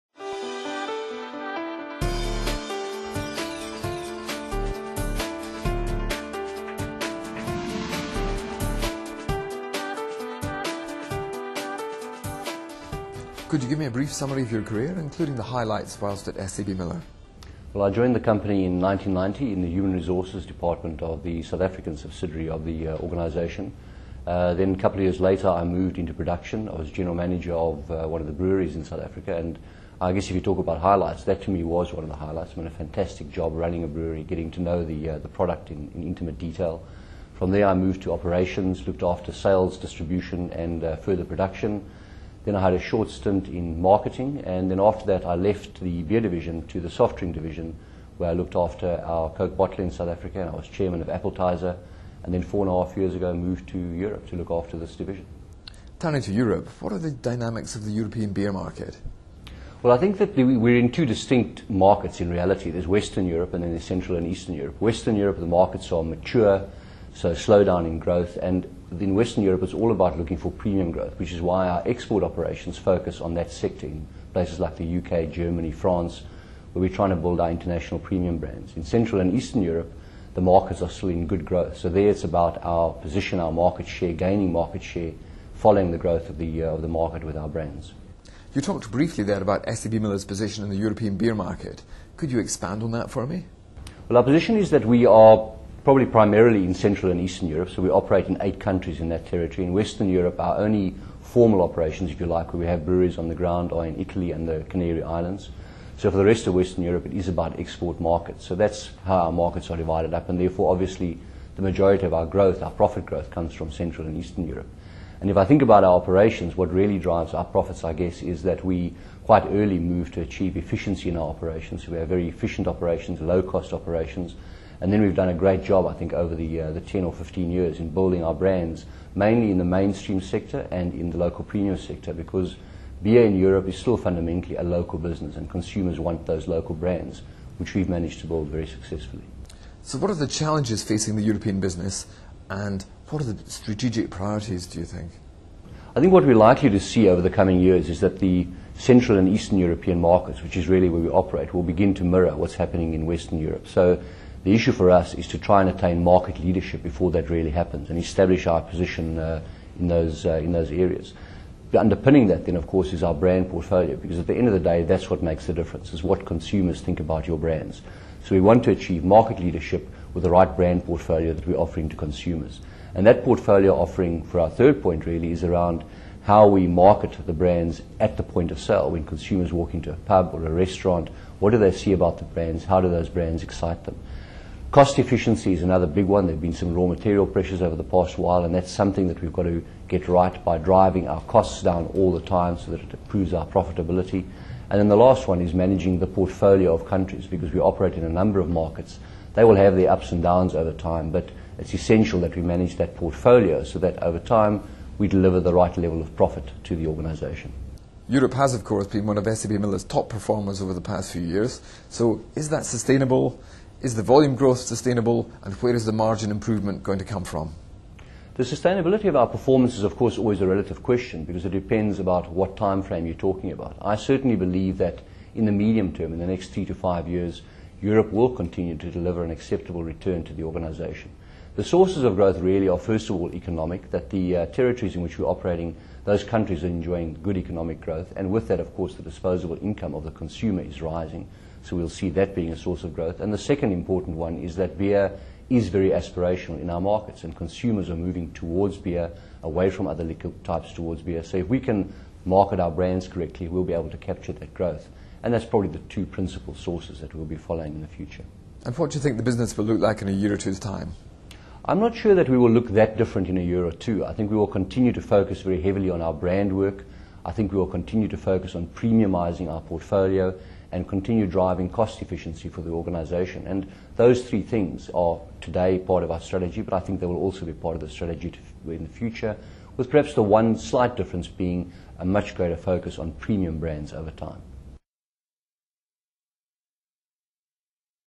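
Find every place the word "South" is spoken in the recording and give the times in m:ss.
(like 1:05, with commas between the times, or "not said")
0:21, 0:28, 0:49.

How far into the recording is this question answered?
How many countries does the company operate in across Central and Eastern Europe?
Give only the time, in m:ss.
1:38.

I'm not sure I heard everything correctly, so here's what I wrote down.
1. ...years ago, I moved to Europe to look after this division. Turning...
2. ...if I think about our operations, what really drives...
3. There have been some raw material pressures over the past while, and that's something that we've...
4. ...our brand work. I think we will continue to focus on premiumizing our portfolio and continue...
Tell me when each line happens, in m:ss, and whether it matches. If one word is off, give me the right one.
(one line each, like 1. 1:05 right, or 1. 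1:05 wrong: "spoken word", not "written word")
1. 0:52 right
2. 1:55 right
3. 3:06 right
4. 4:26 right.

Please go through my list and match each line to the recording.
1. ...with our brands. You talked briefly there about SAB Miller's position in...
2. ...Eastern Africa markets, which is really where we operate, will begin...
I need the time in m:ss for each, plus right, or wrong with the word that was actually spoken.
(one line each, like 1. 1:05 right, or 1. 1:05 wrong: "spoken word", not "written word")
1. 1:27 right
2. 2:29 wrong: "European", not "Africa".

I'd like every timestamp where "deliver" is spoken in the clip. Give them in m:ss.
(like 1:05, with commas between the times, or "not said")
3:25, 3:48.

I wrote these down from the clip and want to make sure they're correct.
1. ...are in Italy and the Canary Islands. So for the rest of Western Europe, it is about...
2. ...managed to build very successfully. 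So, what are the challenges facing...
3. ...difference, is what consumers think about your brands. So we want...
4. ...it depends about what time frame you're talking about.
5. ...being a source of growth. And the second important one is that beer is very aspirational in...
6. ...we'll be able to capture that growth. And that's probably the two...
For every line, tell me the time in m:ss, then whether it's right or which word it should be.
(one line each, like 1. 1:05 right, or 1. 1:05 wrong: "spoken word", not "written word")
1. 1:43 right
2. 2:17 right
3. 2:45 right
4. 3:41 right
5. 4:02 right
6. 4:13 right.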